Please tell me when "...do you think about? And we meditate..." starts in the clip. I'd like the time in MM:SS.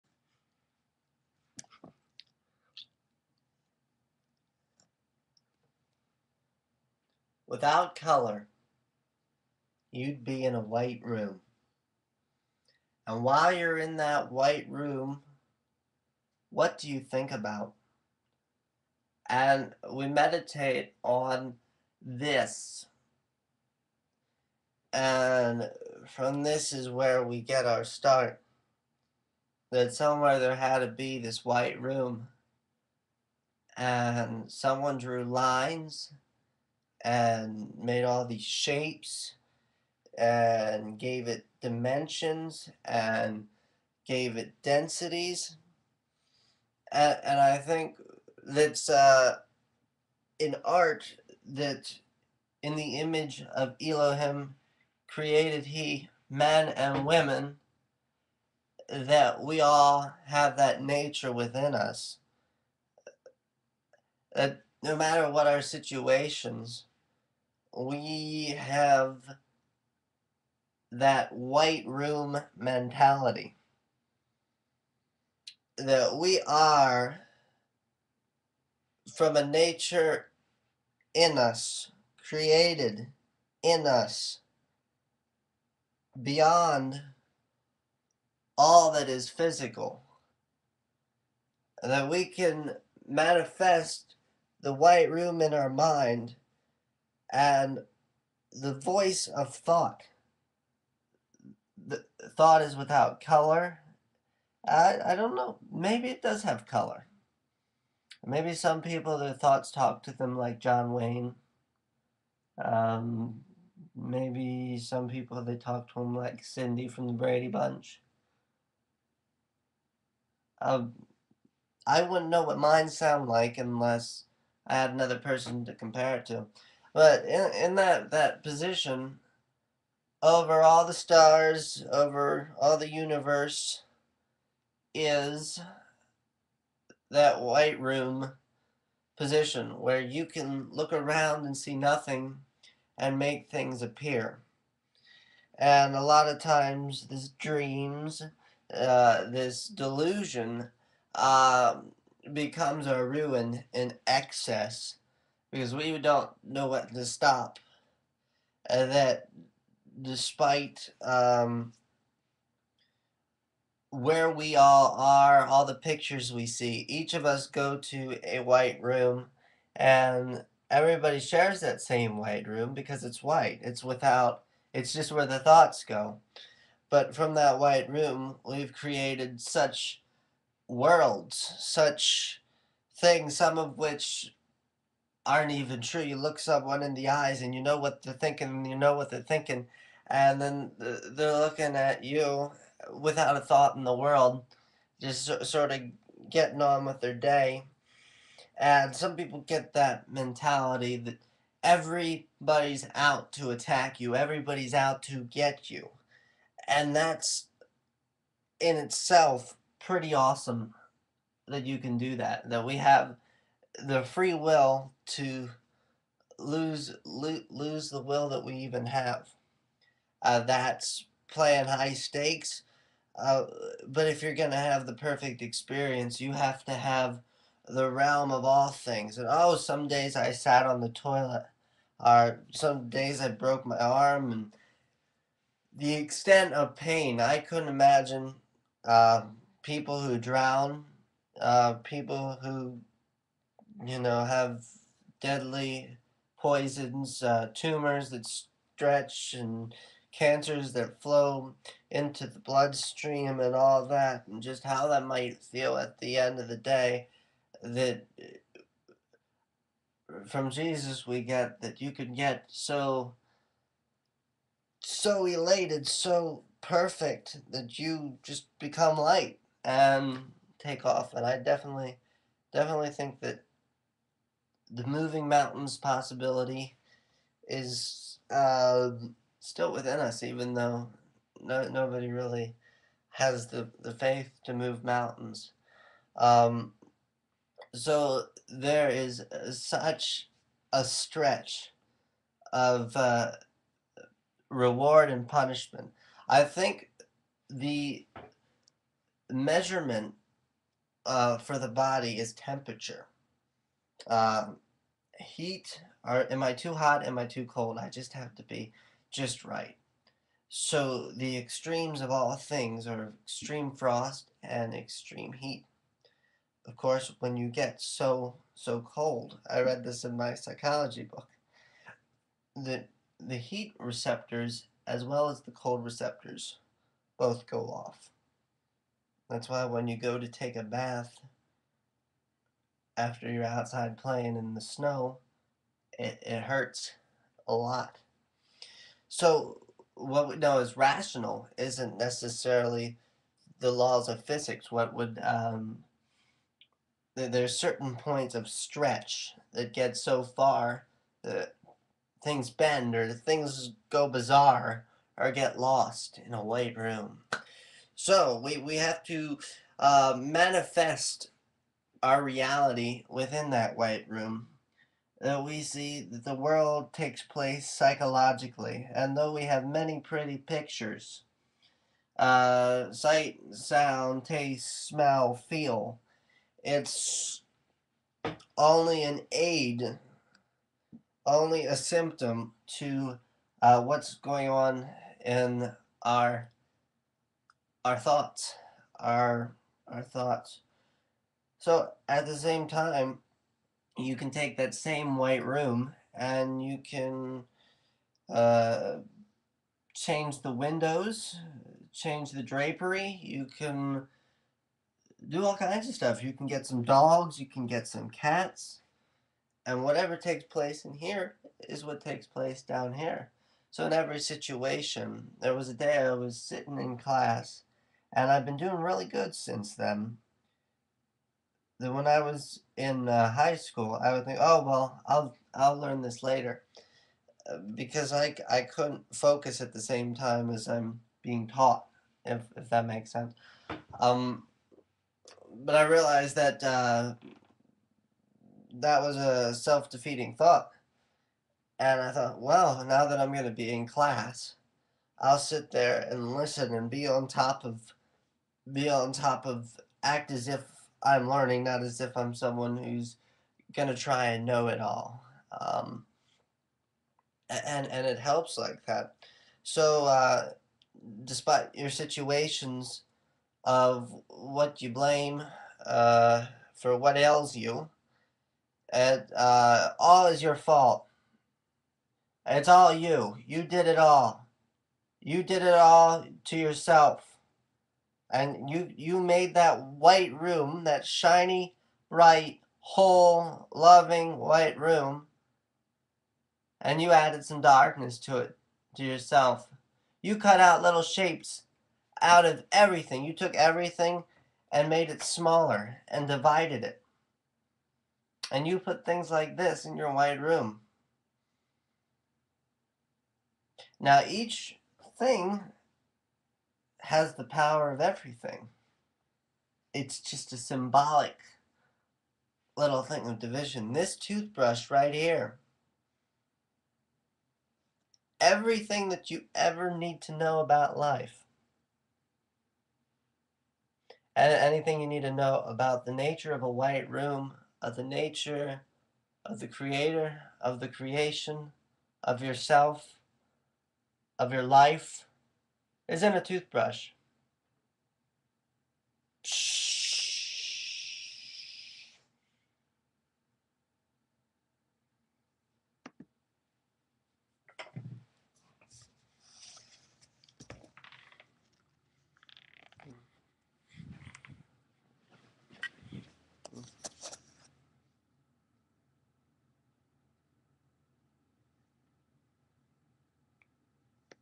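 00:16.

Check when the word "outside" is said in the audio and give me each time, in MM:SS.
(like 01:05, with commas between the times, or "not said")
05:33.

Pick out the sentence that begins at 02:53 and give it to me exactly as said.
It's without, it's just where the thoughts go.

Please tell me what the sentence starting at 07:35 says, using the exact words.
Um, and and it helps like that.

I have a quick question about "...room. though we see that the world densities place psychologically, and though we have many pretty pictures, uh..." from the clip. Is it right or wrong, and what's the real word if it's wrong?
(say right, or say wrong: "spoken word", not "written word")
wrong: "takes", not "densities".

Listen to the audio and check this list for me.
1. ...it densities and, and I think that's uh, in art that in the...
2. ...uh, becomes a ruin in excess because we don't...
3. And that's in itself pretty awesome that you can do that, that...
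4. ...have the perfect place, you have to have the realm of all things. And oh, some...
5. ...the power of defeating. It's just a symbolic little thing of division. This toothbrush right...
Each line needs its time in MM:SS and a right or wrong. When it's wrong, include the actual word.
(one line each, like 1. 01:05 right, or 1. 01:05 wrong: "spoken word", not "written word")
1. 00:44 right
2. 02:31 right
3. 03:26 right
4. 03:44 wrong: "experience", not "place"
5. 08:27 wrong: "everything", not "defeating".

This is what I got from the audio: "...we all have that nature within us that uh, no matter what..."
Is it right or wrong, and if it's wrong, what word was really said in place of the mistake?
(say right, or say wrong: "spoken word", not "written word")
right.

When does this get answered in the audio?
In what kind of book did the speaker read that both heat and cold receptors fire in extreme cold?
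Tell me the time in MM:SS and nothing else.
05:20.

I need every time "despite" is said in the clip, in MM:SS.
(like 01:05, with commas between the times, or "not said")
02:40, 07:41.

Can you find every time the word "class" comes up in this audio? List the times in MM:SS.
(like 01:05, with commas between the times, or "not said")
06:56, 07:23.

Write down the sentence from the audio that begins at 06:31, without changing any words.
So at the same time, you can take that same white room and you can uh, change the windows, change the drapery.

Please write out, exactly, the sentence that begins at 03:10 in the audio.
And then they're looking at you without a thought in the world, just sort of getting on with their day.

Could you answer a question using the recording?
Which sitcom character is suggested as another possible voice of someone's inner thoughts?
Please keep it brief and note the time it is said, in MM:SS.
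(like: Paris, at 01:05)
Cindy from the Brady Bunch, at 01:56.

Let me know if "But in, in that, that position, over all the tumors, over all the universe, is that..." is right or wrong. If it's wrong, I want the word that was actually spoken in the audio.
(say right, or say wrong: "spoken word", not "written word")
wrong: "stars", not "tumors".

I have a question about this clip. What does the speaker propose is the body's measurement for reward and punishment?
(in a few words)
temperature.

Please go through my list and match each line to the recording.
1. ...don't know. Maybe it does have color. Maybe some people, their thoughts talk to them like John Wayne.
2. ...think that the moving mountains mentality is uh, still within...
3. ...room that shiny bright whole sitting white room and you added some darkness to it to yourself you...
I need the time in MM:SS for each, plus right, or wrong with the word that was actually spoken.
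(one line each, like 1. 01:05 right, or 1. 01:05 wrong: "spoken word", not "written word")
1. 01:45 right
2. 04:32 wrong: "possibility", not "mentality"
3. 08:00 wrong: "loving", not "sitting".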